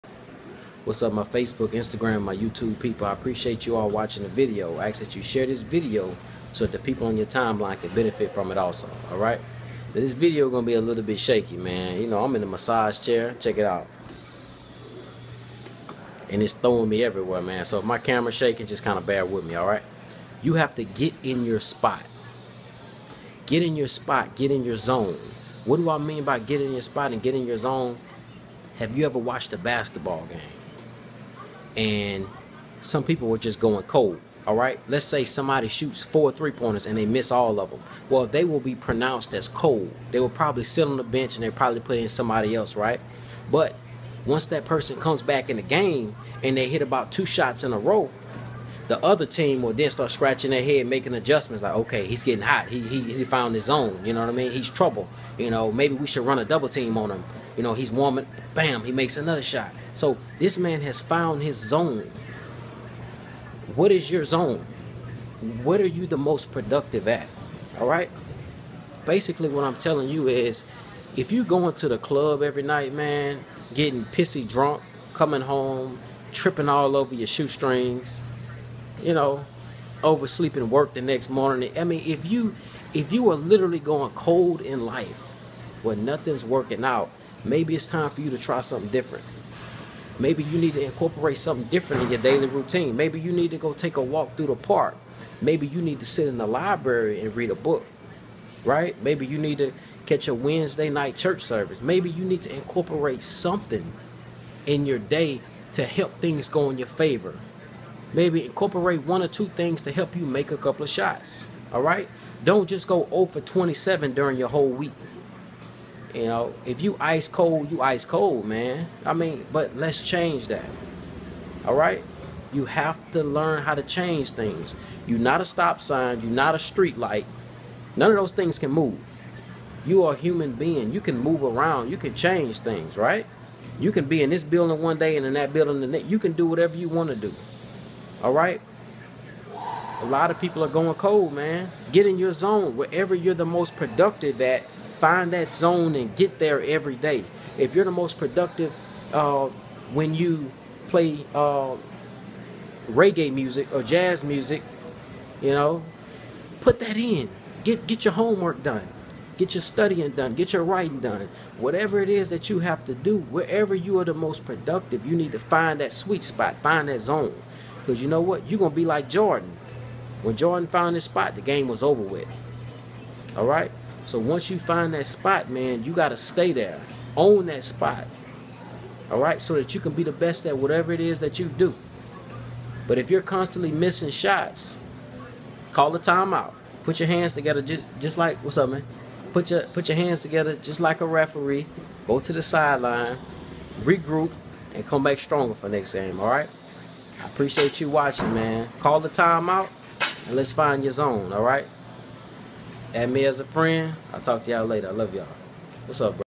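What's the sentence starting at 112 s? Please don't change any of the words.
Don't just go 0 for 27 during your whole week.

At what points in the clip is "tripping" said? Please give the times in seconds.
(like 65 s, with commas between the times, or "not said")
76 s.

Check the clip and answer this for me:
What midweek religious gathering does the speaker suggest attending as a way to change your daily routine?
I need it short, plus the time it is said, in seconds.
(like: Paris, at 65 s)
Wednesday night church service, at 100 s.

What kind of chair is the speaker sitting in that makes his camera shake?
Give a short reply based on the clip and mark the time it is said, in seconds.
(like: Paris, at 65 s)
massage chair, at 12 s.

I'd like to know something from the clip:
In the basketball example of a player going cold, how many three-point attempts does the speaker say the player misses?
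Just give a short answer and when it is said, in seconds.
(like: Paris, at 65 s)
4, at 36 s.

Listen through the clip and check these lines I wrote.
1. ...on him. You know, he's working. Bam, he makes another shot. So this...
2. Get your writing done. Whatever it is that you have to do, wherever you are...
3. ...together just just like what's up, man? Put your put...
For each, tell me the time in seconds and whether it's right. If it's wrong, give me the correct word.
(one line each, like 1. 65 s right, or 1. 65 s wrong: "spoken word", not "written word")
1. 56 s wrong: "warming", not "working"
2. 160 s right
3. 187 s right.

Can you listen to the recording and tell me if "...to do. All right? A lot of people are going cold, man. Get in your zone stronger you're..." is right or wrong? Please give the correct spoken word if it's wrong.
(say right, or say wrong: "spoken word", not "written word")
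wrong: "wherever", not "stronger".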